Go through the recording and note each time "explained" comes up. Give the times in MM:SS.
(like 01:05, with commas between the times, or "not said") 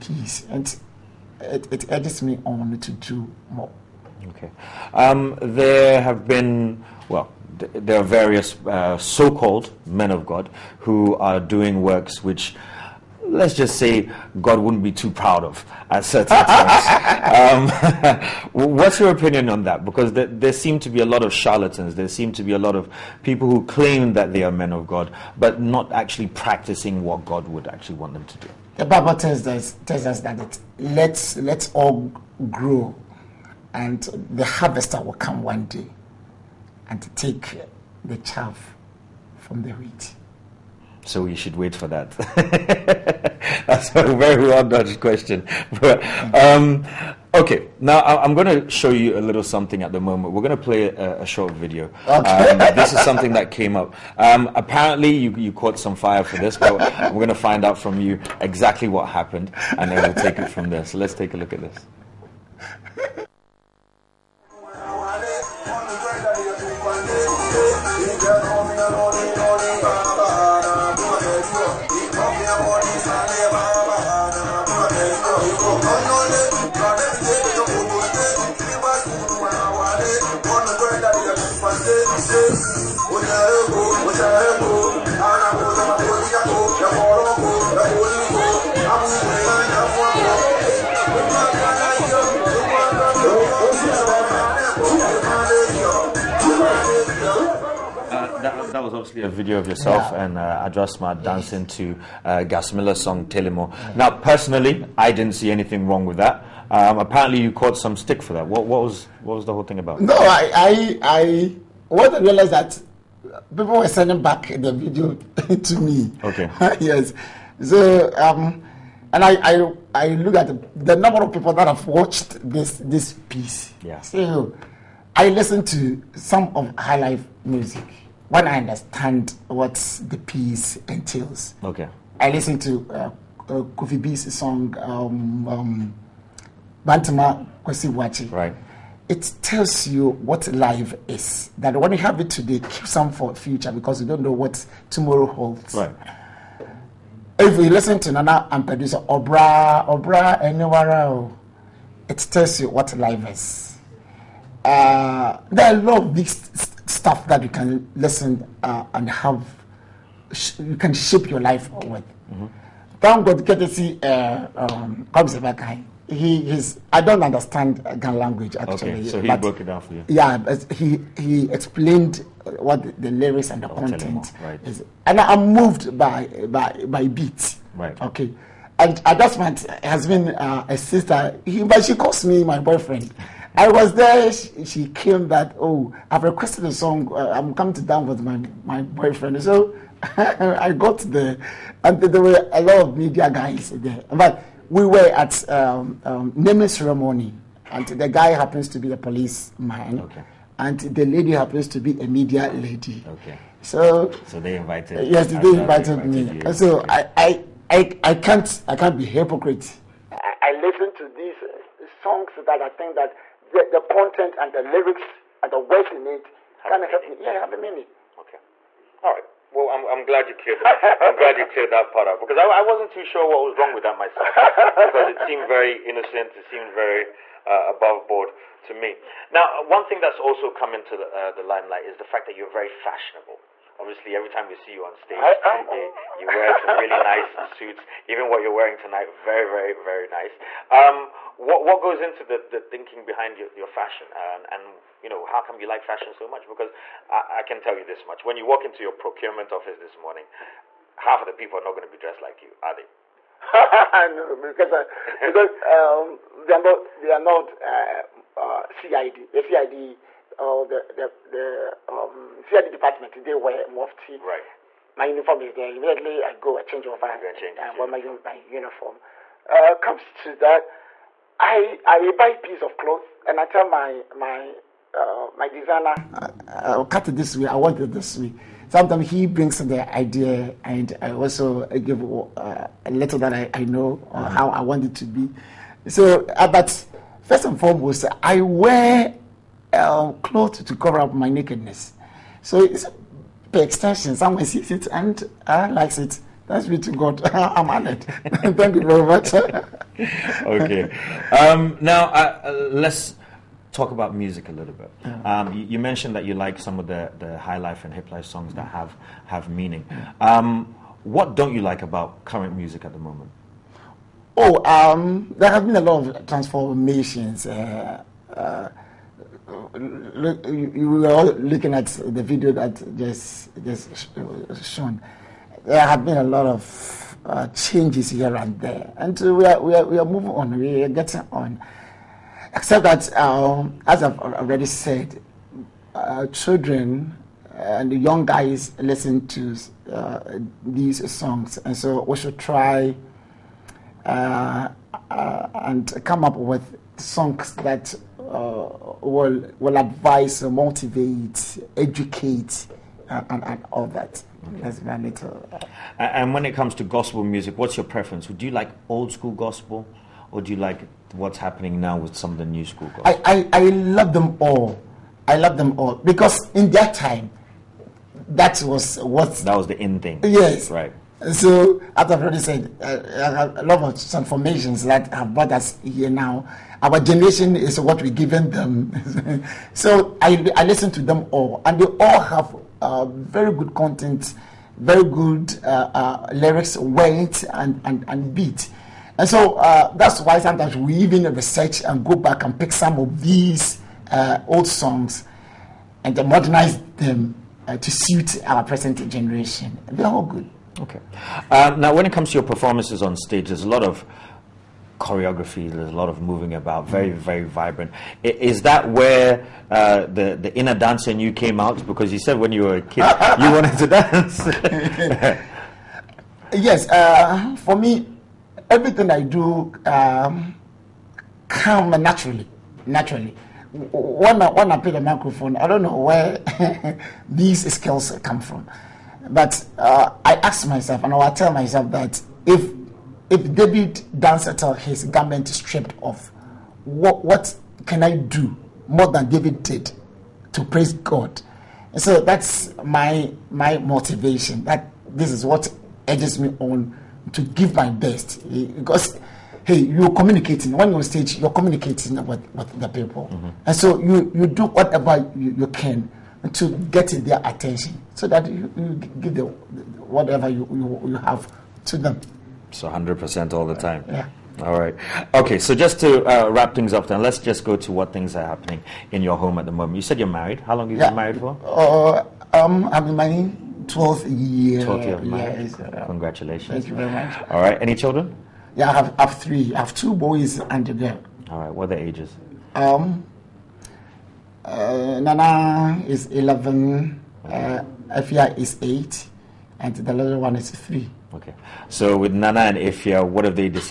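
02:51.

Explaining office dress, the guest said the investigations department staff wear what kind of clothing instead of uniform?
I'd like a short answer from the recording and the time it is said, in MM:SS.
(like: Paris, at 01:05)
mufti, at 04:23.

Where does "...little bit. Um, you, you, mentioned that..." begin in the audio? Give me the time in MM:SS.
05:04.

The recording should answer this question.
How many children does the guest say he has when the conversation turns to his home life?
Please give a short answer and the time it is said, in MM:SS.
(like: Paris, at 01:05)
3, at 07:59.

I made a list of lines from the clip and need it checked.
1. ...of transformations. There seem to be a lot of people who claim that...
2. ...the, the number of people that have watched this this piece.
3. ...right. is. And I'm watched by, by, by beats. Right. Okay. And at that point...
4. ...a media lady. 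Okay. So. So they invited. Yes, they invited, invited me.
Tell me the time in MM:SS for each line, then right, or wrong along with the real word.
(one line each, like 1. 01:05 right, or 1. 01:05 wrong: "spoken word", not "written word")
1. 00:21 wrong: "charlatans", not "transformations"
2. 02:00 right
3. 02:54 wrong: "moved", not "watched"
4. 03:22 right.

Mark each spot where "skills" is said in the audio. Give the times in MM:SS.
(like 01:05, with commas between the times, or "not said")
07:07.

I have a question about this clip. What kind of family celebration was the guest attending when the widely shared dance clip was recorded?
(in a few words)
naming ceremony.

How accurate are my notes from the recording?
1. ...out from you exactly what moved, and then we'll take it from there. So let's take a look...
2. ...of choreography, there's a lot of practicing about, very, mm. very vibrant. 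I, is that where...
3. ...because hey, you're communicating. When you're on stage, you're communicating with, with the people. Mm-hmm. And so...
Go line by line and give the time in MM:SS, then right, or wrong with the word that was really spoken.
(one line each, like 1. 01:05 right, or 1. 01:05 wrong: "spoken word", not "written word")
1. 00:57 wrong: "happened", not "moved"
2. 06:43 wrong: "moving", not "practicing"
3. 07:28 right.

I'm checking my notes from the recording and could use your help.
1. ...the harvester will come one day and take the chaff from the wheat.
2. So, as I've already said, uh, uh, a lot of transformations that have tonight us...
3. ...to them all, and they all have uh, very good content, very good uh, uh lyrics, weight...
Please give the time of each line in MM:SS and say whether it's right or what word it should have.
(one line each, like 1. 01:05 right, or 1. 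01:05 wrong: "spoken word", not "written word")
1. 00:34 right
2. 06:11 wrong: "brought", not "tonight"
3. 06:20 right.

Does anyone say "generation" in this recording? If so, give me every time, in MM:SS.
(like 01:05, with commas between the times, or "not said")
06:16, 06:39.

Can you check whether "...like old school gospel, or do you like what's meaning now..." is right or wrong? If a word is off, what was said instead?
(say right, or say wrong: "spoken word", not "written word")
wrong: "happening", not "meaning".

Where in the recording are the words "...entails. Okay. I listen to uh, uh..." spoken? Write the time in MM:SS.
02:10.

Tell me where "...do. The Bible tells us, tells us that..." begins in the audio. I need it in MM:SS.
00:28.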